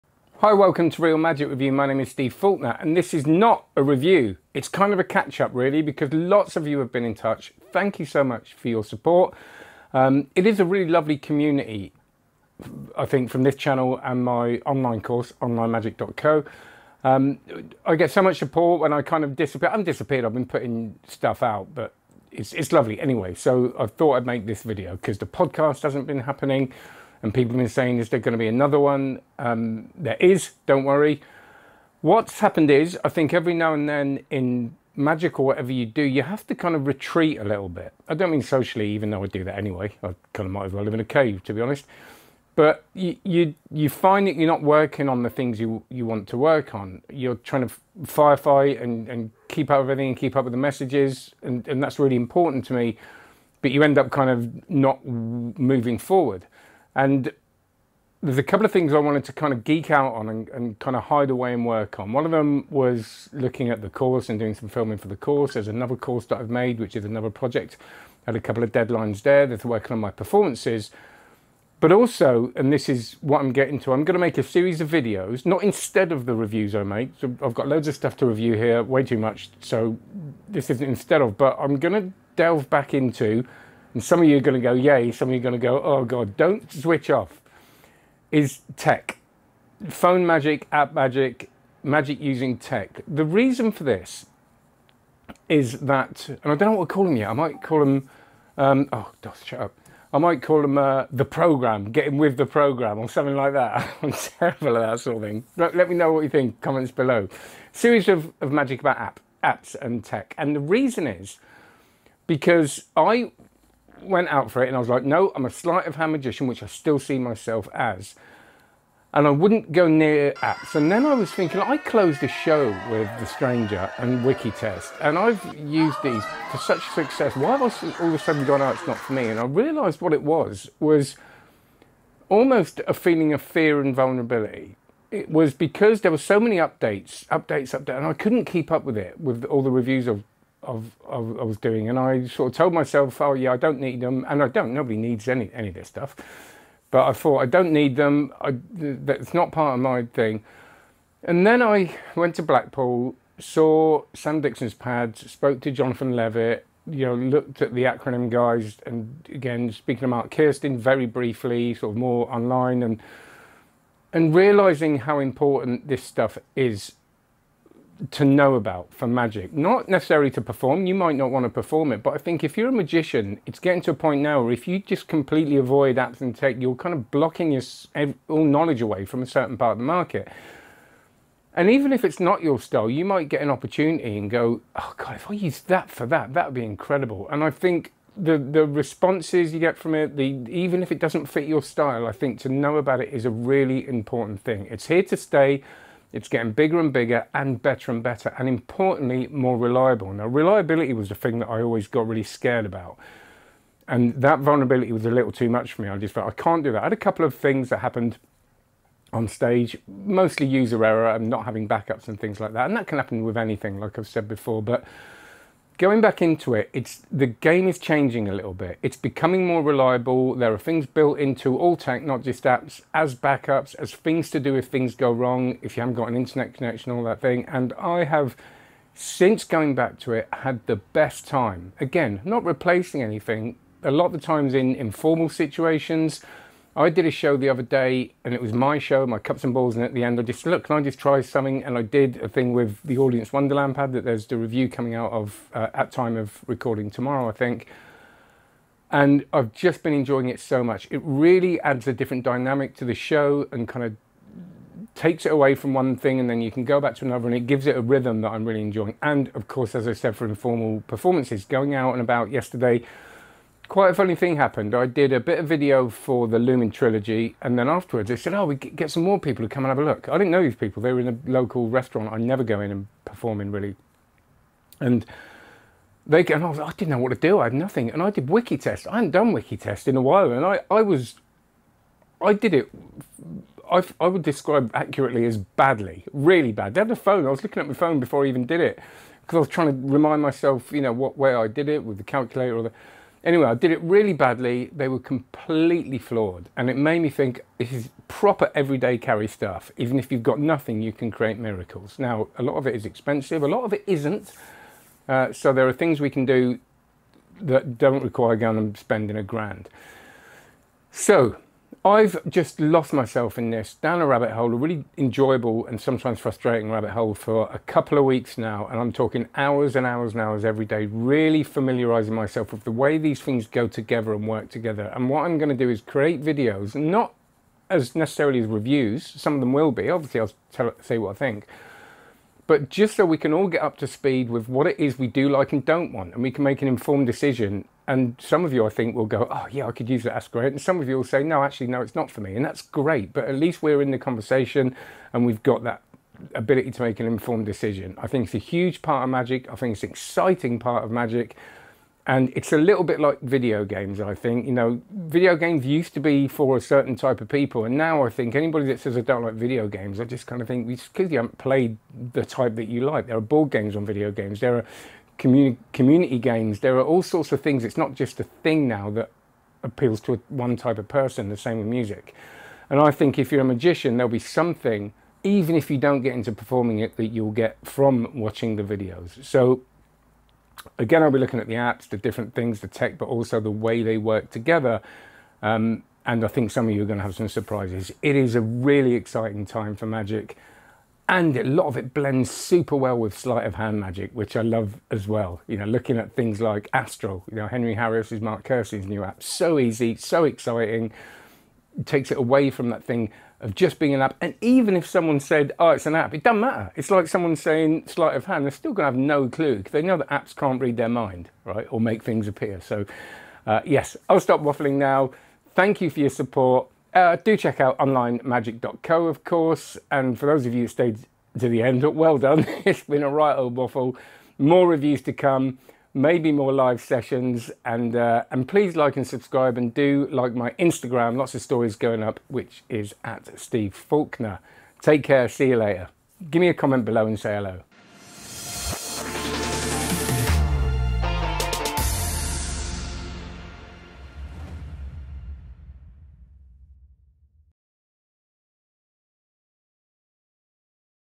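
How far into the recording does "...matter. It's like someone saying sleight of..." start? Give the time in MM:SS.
06:46.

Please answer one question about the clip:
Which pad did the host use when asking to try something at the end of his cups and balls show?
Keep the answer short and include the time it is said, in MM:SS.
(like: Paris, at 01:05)
Audience Wonderland pad, at 04:02.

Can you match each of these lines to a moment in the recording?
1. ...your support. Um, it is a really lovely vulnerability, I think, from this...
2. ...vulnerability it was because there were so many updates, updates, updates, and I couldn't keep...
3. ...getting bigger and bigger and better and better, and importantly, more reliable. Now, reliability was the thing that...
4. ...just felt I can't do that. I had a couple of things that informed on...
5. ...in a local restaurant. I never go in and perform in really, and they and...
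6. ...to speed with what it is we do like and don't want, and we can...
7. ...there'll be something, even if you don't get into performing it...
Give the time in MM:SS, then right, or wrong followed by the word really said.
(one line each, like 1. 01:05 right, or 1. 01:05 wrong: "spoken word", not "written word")
1. 00:08 wrong: "community", not "vulnerability"
2. 02:13 right
3. 03:16 right
4. 03:25 wrong: "happened", not "informed"
5. 04:30 right
6. 05:33 right
7. 06:13 right.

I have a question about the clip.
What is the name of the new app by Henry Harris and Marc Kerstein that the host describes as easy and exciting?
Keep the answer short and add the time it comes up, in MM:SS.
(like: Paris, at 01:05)
Astral, at 06:36.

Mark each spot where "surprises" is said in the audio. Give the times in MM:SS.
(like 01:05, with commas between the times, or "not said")
06:27.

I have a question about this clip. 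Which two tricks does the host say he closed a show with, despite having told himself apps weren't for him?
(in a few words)
The Stranger and Wiki Test.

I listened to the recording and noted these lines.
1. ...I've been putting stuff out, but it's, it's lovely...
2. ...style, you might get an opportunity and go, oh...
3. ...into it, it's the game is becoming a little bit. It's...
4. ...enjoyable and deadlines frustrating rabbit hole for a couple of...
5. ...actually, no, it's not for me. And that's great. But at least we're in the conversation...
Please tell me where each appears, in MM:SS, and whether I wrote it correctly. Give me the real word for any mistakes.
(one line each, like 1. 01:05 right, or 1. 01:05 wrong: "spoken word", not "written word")
1. 00:20 right
2. 03:02 right
3. 03:36 wrong: "changing", not "becoming"
4. 05:14 wrong: "sometimes", not "deadlines"
5. 05:41 right.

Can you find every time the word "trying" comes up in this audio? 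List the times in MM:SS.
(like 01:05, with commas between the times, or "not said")
00:47, 04:49.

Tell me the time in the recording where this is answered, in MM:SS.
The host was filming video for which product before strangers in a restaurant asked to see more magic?
04:26.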